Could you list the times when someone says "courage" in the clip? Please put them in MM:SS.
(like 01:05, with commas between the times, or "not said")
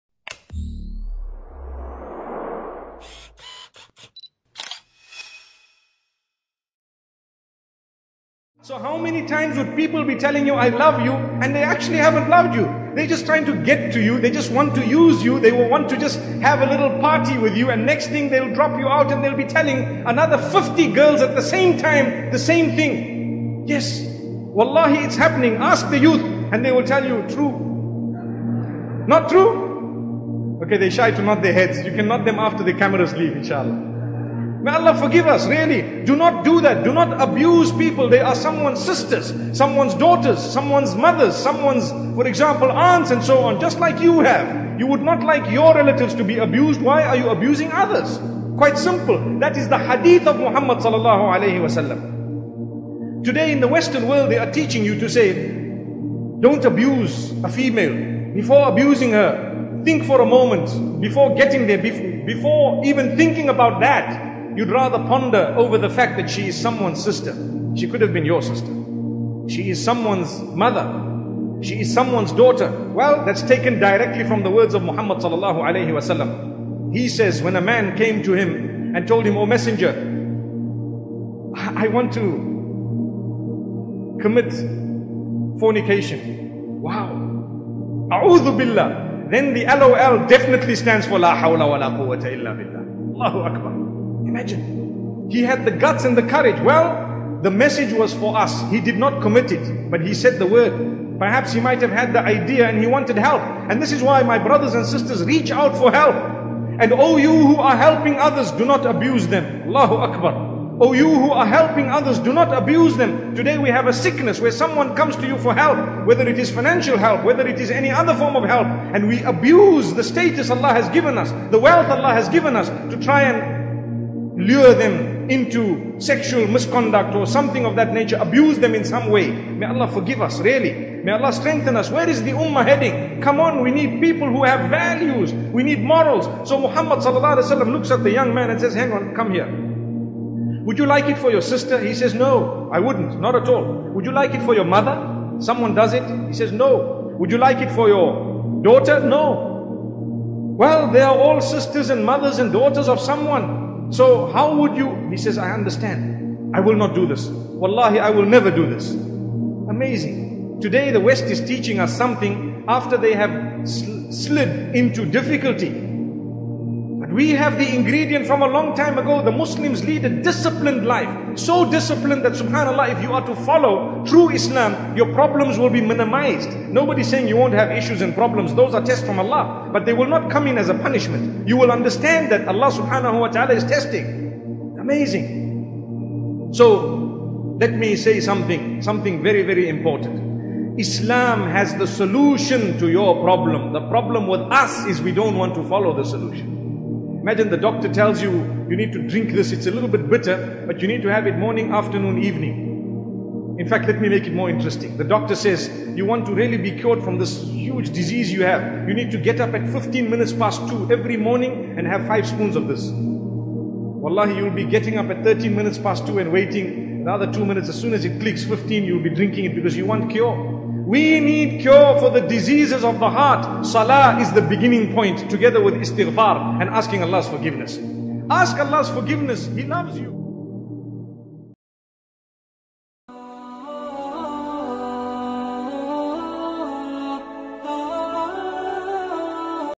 01:36.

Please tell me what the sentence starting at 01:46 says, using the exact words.
And oh you who are helping others, do not abuse them.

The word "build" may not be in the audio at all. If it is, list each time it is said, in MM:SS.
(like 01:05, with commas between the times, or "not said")
not said.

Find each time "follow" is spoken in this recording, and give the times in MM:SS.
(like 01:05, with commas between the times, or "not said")
02:53, 03:15.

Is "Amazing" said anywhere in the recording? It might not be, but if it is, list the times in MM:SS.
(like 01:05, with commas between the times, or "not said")
02:38, 03:04.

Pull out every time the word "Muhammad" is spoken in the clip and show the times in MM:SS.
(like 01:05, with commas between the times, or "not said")
00:50, 01:14, 02:16.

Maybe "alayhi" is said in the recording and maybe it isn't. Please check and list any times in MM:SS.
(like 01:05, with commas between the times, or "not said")
00:51, 01:15.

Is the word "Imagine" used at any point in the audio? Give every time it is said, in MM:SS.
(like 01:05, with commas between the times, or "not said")
01:34, 03:17.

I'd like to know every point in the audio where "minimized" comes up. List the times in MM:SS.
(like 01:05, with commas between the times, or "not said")
02:55.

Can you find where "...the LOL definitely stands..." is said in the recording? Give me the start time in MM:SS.
01:29.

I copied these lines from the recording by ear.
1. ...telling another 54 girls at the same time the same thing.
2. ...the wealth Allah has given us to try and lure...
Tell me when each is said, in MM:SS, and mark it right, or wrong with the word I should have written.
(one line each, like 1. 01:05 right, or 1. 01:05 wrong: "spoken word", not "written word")
1. 00:19 wrong: "50", not "54"
2. 02:01 right.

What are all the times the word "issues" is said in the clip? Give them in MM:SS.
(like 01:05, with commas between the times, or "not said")
02:57.